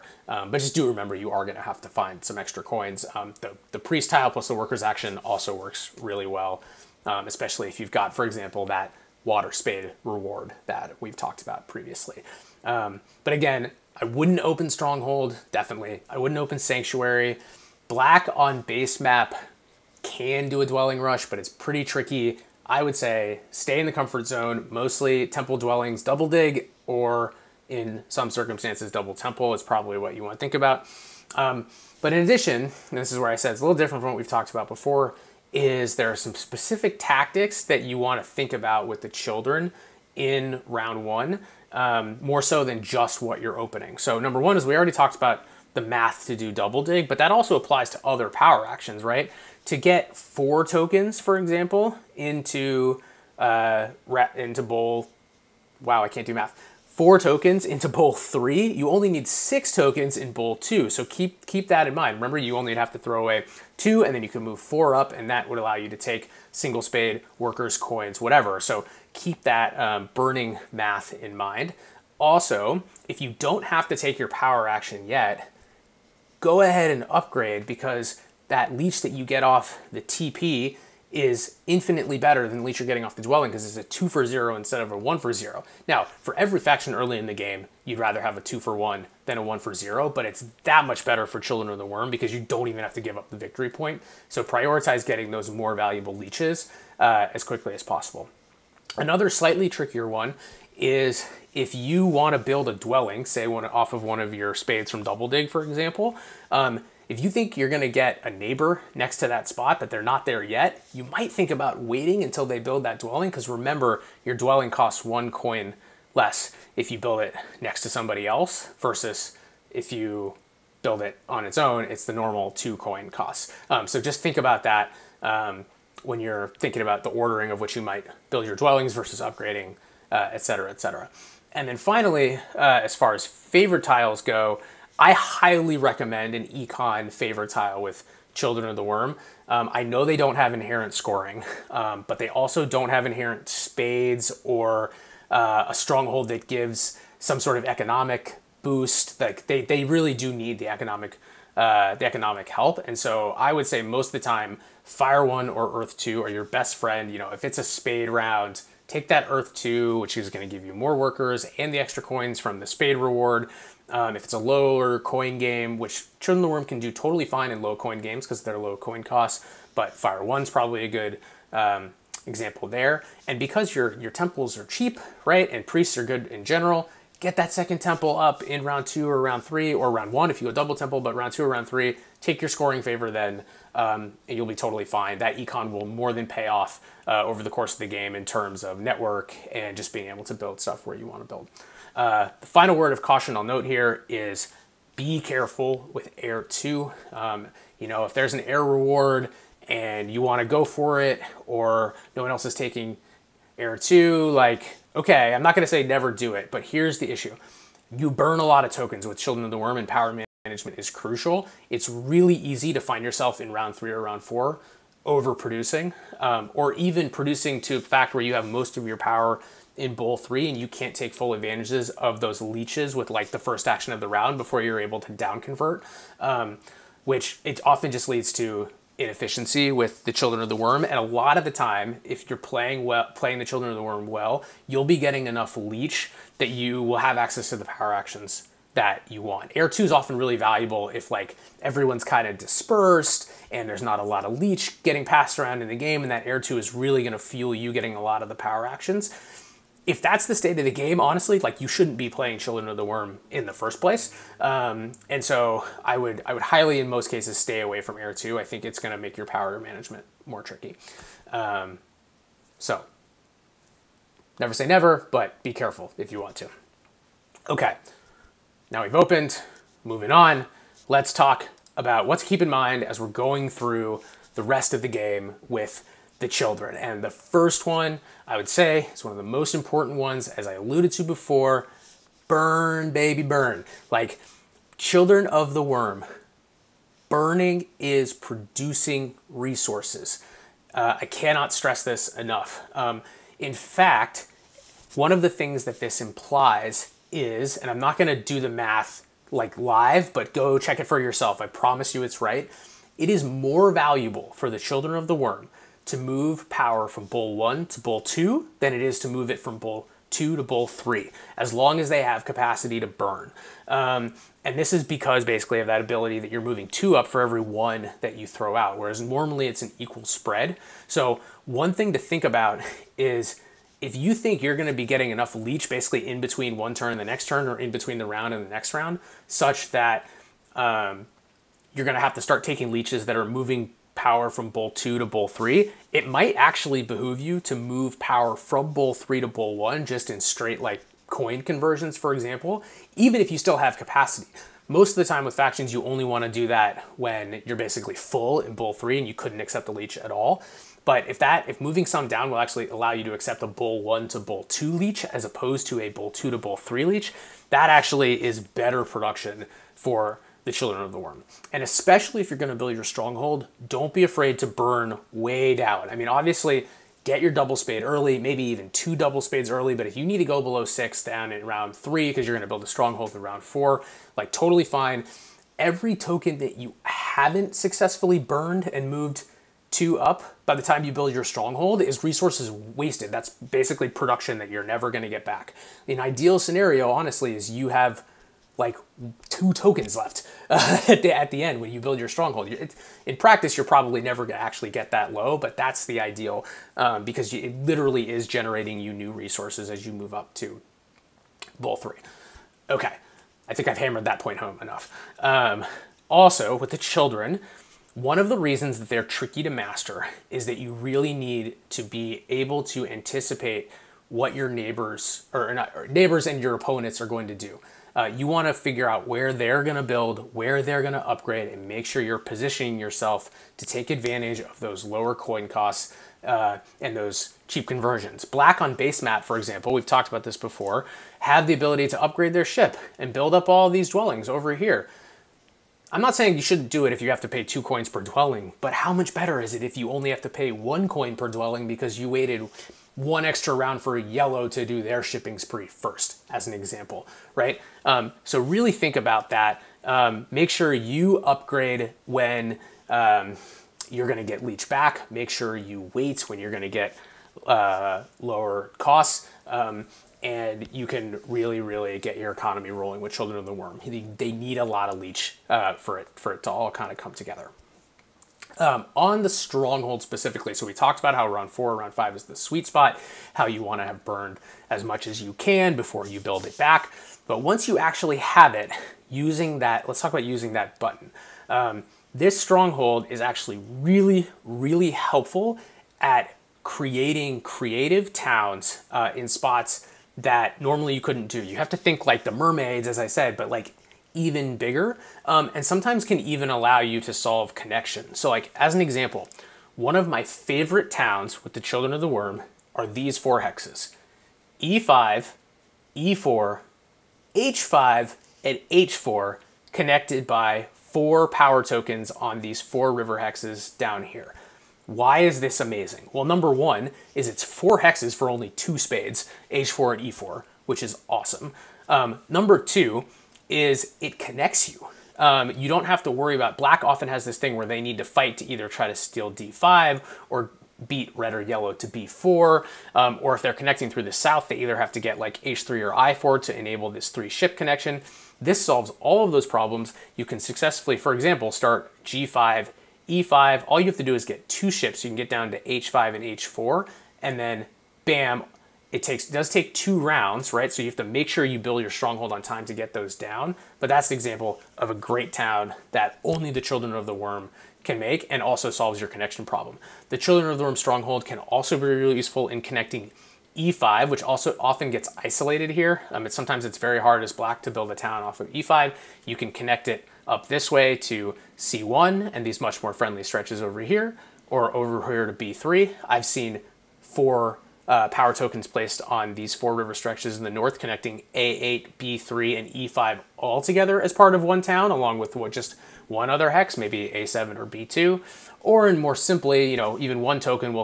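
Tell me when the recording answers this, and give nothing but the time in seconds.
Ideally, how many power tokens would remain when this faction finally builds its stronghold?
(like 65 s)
389 s.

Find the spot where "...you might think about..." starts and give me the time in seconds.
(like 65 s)
110 s.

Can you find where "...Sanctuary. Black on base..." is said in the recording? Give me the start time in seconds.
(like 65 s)
16 s.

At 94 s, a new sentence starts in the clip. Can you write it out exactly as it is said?
So prioritize getting those more valuable leeches uh, as quickly as possible.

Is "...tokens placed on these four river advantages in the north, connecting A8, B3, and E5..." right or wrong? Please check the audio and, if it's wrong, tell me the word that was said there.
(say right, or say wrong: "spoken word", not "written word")
wrong: "stretches", not "advantages".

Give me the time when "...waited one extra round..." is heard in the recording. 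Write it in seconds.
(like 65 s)
442 s.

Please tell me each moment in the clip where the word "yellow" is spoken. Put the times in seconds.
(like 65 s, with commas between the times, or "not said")
443 s, 531 s.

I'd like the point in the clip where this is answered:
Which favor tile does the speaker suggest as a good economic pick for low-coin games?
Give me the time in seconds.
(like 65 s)
169 s.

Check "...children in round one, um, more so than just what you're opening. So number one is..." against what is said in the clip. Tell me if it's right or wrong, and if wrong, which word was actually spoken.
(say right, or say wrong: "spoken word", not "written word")
right.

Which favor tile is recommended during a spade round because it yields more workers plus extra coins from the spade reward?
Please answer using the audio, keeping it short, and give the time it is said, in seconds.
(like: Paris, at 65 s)
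Earth 2, at 159 s.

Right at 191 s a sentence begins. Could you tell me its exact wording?
Uh, the final word of caution I'll note here is be careful with air two.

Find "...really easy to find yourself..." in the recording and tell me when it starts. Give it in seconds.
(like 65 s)
211 s.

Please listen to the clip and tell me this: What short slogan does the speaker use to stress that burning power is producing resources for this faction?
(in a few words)
burn, baby, burn.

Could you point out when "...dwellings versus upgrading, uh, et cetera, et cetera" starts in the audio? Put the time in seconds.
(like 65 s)
128 s.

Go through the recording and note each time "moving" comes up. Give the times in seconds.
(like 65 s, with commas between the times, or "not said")
269 s, 316 s, 333 s, 351 s.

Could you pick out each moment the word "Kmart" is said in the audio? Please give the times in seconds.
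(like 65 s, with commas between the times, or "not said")
not said.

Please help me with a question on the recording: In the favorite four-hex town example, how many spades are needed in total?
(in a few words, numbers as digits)
2.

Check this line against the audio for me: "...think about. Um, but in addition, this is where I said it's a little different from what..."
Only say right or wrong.
right.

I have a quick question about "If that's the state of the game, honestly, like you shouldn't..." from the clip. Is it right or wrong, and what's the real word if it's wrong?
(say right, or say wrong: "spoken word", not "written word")
right.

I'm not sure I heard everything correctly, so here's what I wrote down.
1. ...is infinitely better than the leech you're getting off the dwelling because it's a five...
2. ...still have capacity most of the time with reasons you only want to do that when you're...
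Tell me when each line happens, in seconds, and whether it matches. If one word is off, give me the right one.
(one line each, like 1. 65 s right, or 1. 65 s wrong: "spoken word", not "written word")
1. 81 s wrong: "two", not "five"
2. 343 s wrong: "factions", not "reasons".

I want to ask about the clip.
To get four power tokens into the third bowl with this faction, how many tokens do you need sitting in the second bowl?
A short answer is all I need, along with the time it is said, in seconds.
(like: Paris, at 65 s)
6, at 59 s.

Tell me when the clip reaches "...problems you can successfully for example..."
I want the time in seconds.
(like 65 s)
539 s.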